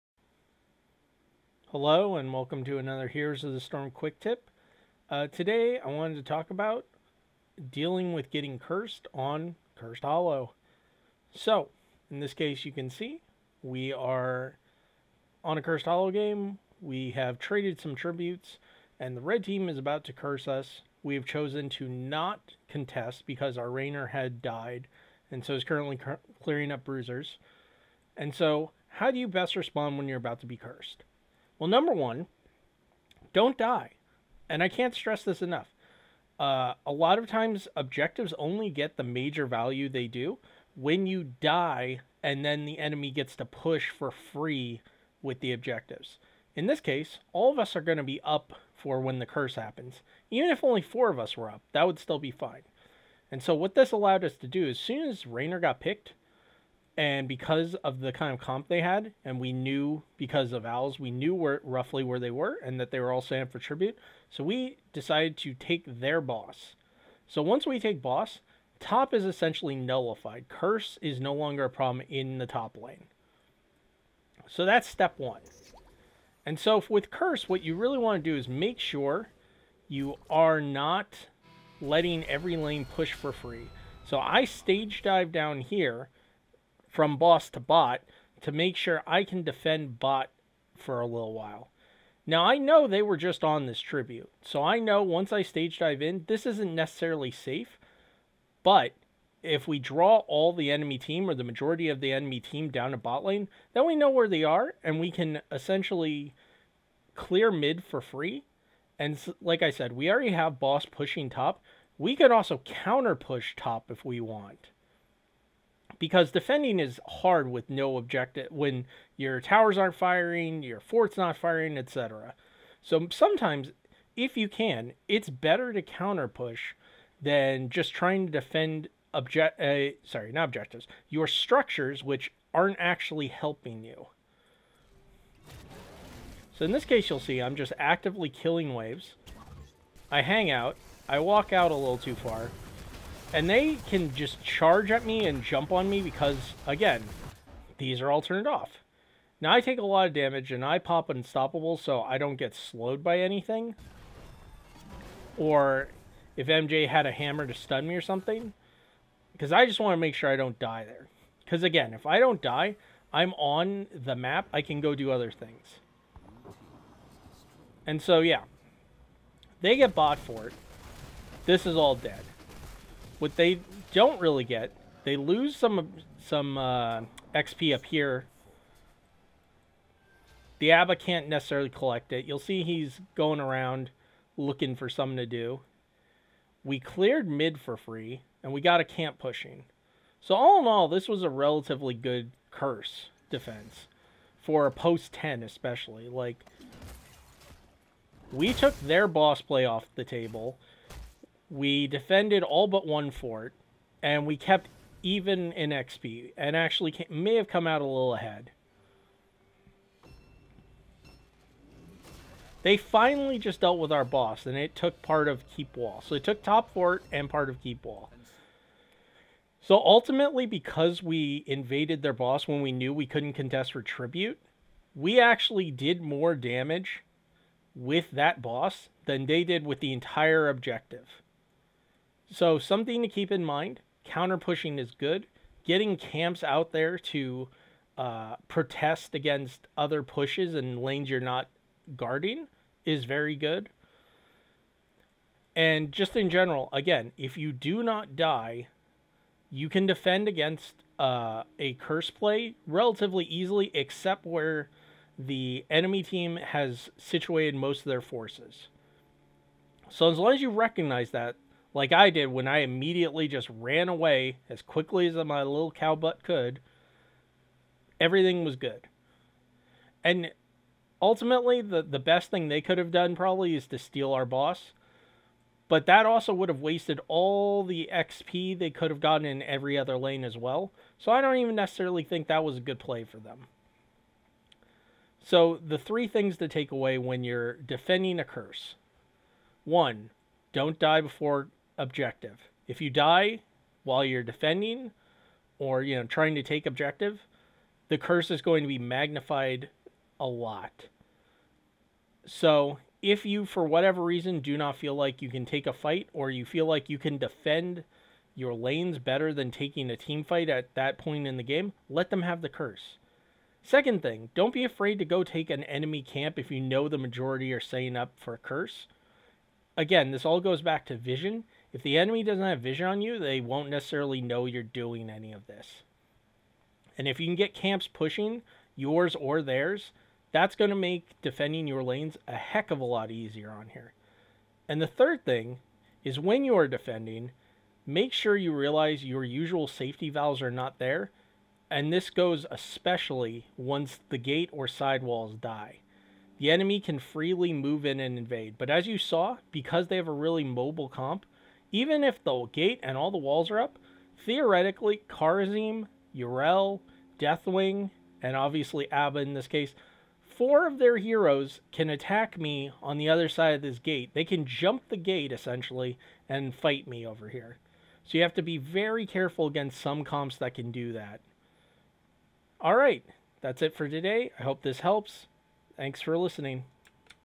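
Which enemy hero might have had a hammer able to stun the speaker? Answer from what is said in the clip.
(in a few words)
MJ.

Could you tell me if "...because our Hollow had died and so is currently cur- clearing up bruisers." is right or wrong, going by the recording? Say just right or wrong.
wrong.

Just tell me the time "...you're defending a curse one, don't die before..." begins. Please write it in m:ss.
4:47.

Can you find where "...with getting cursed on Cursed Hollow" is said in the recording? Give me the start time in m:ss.
0:08.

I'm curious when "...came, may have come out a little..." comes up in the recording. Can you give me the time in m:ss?
3:26.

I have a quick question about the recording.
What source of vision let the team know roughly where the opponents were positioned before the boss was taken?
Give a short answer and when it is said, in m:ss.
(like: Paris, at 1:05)
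Owls, at 1:00.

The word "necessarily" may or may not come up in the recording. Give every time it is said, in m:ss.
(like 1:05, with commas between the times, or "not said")
1:36, 3:01, 4:41, 5:23.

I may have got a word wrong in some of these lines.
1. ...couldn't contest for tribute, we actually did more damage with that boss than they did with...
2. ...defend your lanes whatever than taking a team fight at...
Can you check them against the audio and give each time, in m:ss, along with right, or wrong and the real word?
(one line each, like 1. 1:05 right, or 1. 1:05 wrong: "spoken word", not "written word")
1. 3:43 right
2. 5:07 wrong: "better", not "whatever".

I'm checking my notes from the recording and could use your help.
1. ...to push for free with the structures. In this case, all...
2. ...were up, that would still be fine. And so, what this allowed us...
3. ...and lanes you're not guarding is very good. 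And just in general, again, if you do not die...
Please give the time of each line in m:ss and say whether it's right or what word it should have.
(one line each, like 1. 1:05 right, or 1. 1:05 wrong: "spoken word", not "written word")
1. 0:43 wrong: "objectives", not "structures"
2. 0:51 right
3. 4:00 right.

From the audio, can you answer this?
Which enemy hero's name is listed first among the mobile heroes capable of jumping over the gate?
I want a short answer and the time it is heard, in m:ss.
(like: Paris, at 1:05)
Kharazim, at 5:55.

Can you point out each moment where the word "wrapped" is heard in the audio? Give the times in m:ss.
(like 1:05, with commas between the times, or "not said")
not said.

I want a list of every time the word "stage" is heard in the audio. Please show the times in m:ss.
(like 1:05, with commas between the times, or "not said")
1:24, 1:35.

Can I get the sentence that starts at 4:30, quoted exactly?
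And ultimately, the, the best thing they could have done probably is to steal our boss.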